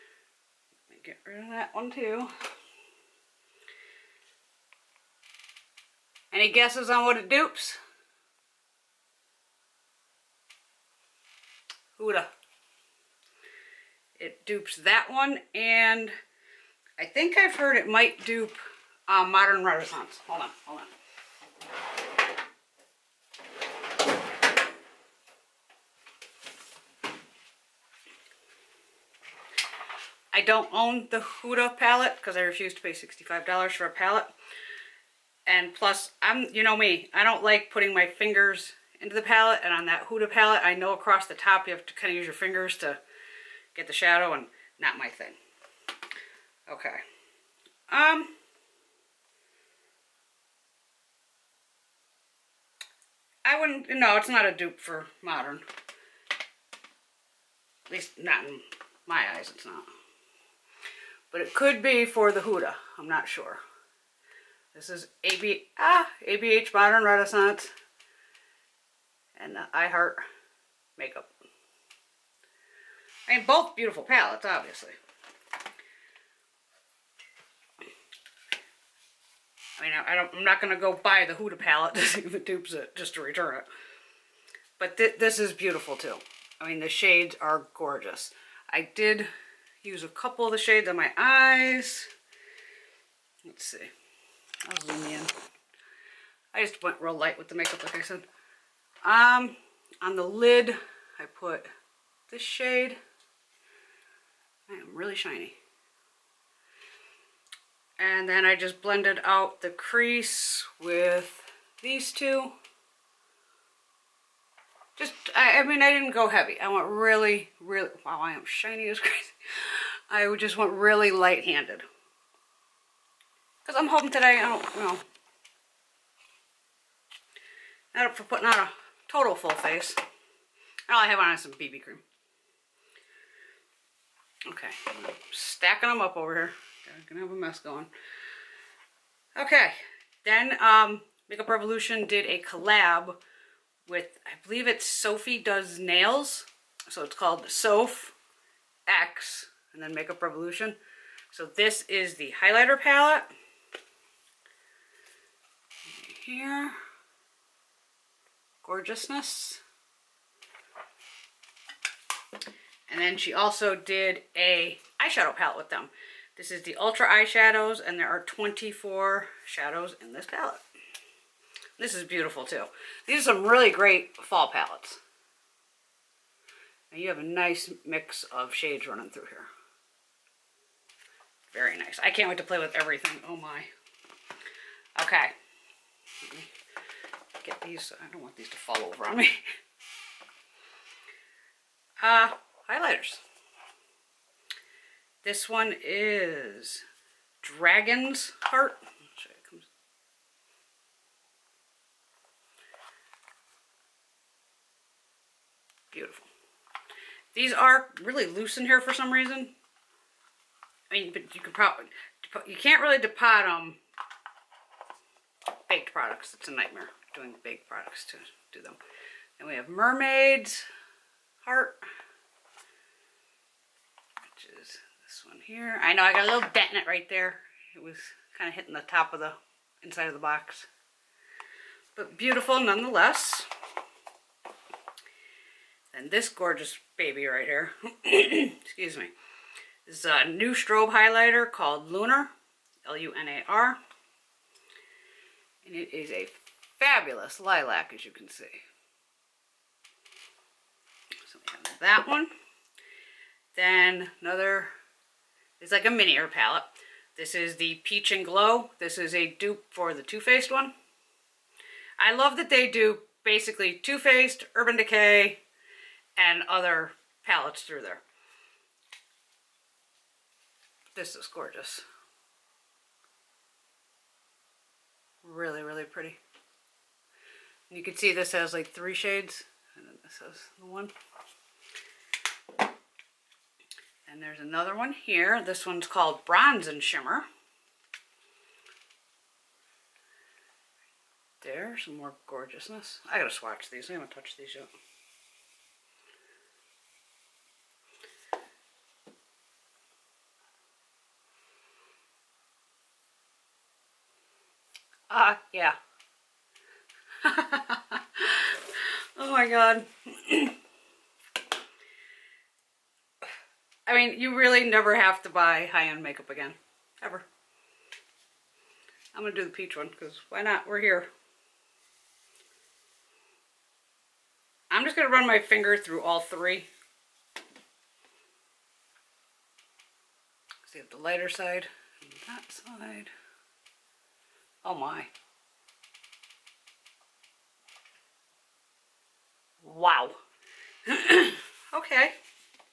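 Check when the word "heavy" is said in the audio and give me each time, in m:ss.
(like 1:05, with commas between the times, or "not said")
1:56.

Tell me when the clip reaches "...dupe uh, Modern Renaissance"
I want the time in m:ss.
0:18.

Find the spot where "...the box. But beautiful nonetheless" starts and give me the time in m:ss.
3:50.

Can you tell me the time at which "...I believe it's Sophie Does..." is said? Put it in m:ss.
2:24.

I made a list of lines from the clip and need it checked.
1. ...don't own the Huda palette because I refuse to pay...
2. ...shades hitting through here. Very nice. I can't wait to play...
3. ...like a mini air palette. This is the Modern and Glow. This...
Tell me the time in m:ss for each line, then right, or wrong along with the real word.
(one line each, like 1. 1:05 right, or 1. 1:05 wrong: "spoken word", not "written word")
1. 0:30 right
2. 2:58 wrong: "running", not "hitting"
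3. 4:15 wrong: "Peach", not "Modern".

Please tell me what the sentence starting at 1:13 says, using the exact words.
I mean, both beautiful palettes, obviously.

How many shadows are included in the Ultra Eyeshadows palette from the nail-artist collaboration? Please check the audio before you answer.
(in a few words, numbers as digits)
24.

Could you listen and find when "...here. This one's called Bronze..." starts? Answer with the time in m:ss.
4:44.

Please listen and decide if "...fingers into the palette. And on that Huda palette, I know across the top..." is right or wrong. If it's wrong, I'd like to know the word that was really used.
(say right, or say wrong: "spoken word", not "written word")
right.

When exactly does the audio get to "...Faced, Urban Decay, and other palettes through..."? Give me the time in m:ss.
4:23.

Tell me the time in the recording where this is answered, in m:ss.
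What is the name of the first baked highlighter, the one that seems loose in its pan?
3:17.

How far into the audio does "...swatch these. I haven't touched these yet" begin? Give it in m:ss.
4:53.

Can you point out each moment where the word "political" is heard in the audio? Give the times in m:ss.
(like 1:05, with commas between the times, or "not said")
not said.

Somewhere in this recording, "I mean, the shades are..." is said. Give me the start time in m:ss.
1:26.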